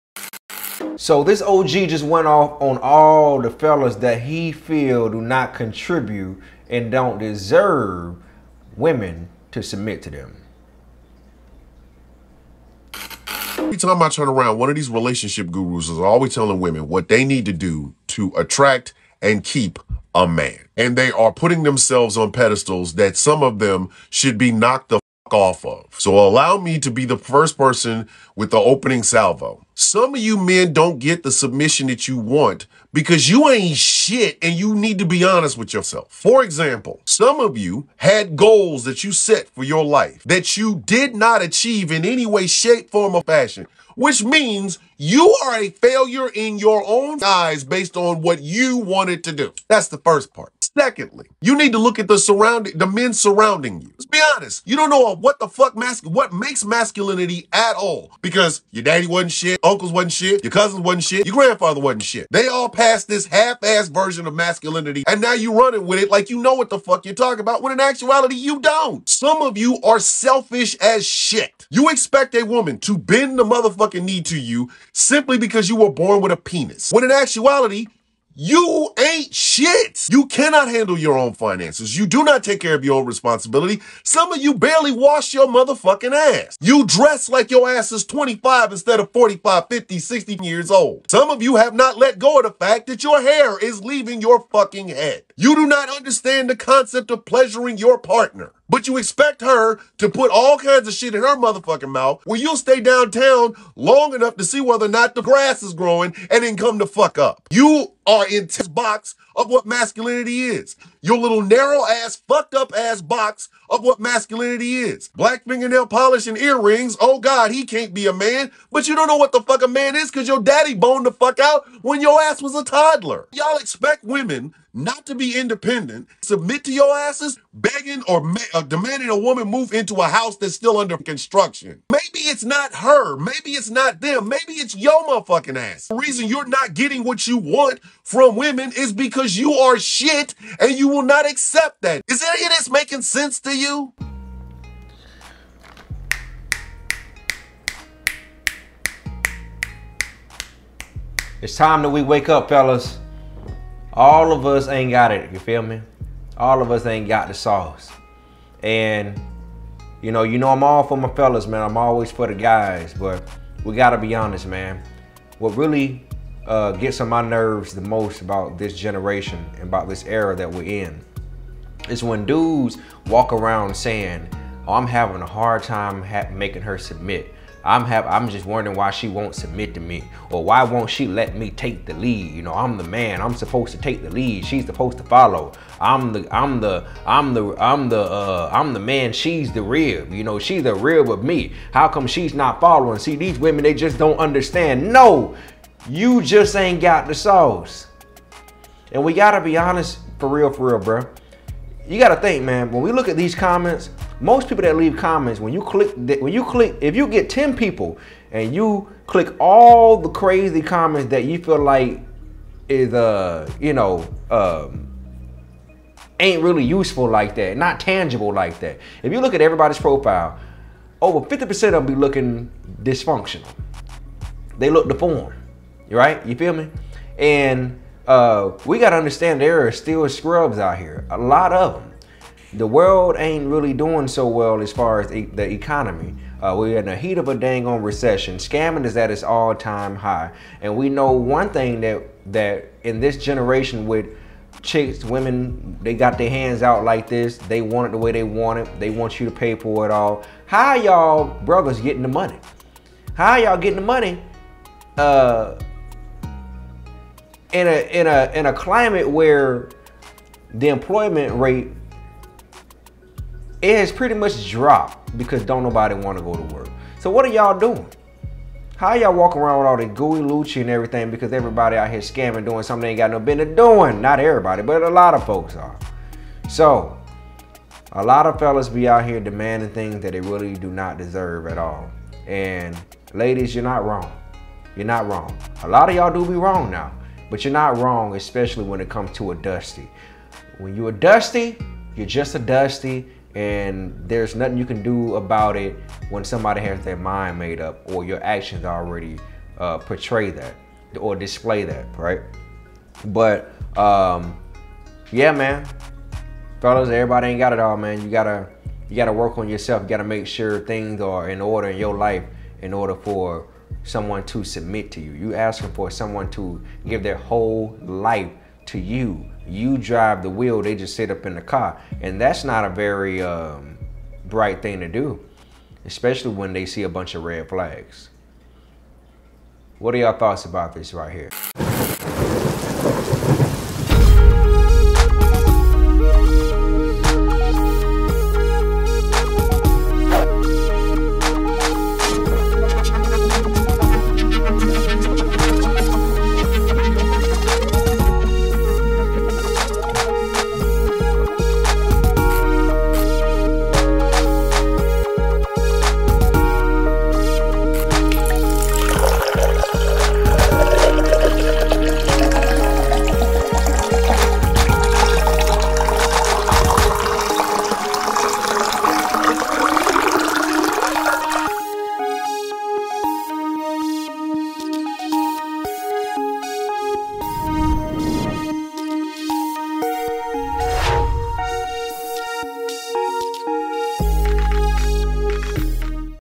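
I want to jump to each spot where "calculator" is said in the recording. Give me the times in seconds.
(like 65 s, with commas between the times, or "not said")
not said.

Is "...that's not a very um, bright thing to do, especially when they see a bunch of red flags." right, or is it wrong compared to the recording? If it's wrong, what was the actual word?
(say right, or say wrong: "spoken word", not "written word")
right.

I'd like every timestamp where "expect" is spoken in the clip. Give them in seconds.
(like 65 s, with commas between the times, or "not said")
71 s, 98 s, 123 s.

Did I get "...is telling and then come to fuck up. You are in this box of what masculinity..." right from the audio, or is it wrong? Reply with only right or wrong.
wrong.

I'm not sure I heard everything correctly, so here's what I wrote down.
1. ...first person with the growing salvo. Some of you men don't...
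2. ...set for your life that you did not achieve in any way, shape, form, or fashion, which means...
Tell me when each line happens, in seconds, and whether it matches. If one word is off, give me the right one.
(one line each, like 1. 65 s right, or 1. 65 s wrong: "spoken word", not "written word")
1. 27 s wrong: "opening", not "growing"
2. 39 s right.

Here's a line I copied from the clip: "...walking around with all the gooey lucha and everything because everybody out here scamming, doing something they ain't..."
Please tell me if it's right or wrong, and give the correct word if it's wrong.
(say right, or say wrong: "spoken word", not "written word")
right.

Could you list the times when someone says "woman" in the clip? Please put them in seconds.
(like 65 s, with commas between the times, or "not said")
72 s, 129 s.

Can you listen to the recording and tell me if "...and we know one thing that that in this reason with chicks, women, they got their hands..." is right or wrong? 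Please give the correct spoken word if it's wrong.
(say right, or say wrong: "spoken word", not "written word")
wrong: "generation", not "reason".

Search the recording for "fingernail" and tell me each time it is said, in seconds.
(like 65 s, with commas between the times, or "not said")
115 s.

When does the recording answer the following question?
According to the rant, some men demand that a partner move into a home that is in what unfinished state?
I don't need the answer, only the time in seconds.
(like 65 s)
130 s.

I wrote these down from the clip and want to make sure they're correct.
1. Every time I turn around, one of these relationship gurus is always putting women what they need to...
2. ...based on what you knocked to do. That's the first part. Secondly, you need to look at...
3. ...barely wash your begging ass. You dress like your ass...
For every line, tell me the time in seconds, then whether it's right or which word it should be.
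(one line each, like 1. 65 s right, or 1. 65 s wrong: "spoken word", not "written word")
1. 13 s wrong: "telling", not "putting"
2. 47 s wrong: "wanted", not "knocked"
3. 84 s wrong: "motherfucking", not "begging".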